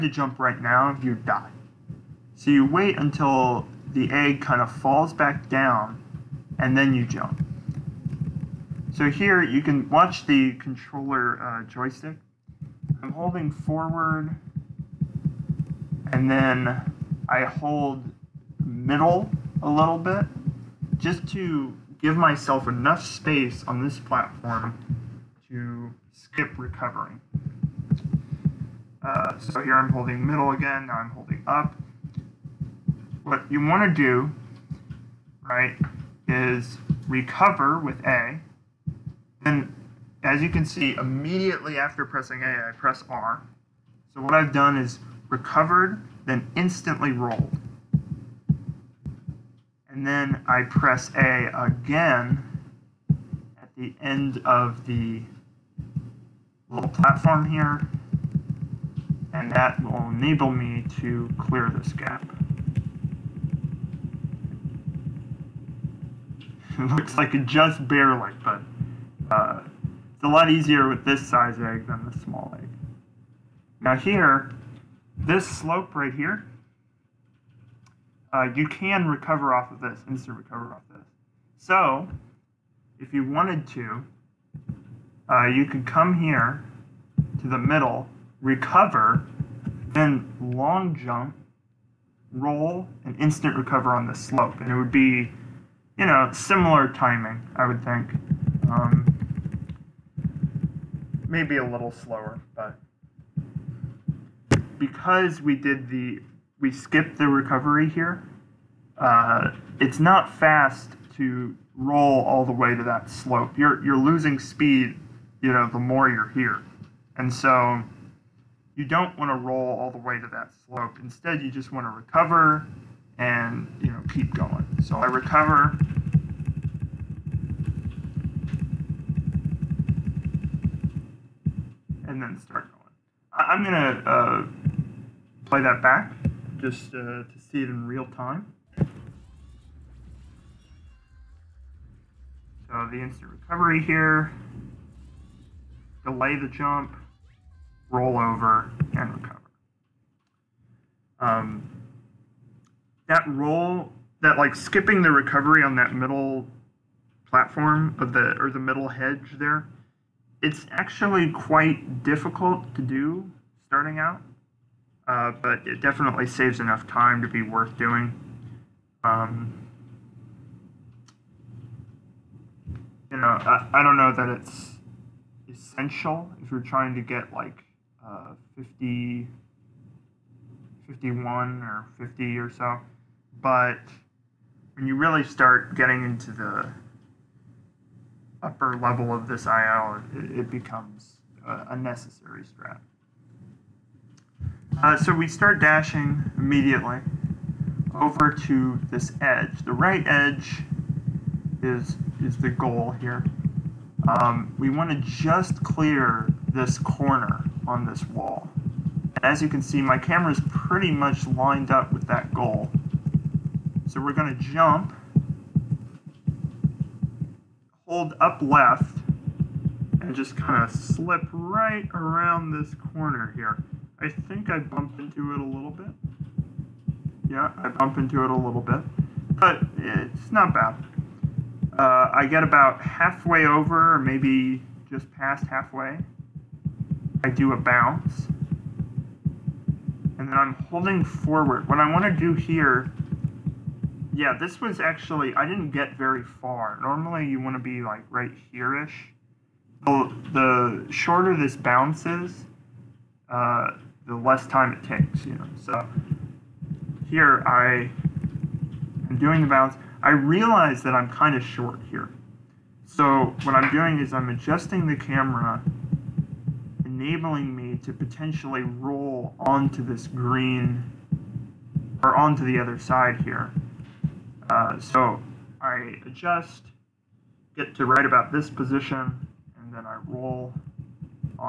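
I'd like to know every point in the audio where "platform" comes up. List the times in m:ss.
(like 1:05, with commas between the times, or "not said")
0:23, 0:56, 2:37.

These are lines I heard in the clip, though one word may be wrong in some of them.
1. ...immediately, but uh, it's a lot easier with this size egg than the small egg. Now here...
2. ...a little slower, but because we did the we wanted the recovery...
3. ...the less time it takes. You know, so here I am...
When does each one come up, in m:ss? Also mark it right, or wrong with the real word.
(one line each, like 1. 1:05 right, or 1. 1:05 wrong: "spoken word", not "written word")
1. 1:07 wrong: "barely", not "immediately"
2. 1:41 wrong: "skipped", not "wanted"
3. 4:14 right.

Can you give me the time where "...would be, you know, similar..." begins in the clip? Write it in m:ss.
1:34.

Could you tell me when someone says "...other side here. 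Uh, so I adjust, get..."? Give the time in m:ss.
4:32.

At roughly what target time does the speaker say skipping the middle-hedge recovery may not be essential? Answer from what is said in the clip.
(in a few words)
50.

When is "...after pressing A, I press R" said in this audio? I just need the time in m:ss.
0:41.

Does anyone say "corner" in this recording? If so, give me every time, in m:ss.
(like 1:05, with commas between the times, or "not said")
3:26, 3:42.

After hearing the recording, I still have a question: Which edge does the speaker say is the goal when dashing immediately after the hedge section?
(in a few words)
The right edge.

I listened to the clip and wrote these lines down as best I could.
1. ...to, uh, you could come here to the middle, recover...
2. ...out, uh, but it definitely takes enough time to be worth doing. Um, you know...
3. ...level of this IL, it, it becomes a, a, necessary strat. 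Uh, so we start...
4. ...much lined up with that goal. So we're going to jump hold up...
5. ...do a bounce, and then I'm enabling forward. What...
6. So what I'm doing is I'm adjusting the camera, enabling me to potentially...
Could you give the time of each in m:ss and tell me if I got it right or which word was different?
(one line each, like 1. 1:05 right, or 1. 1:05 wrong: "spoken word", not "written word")
1. 1:23 right
2. 2:43 wrong: "saves", not "takes"
3. 3:08 right
4. 3:30 right
5. 3:57 wrong: "holding", not "enabling"
6. 4:22 right.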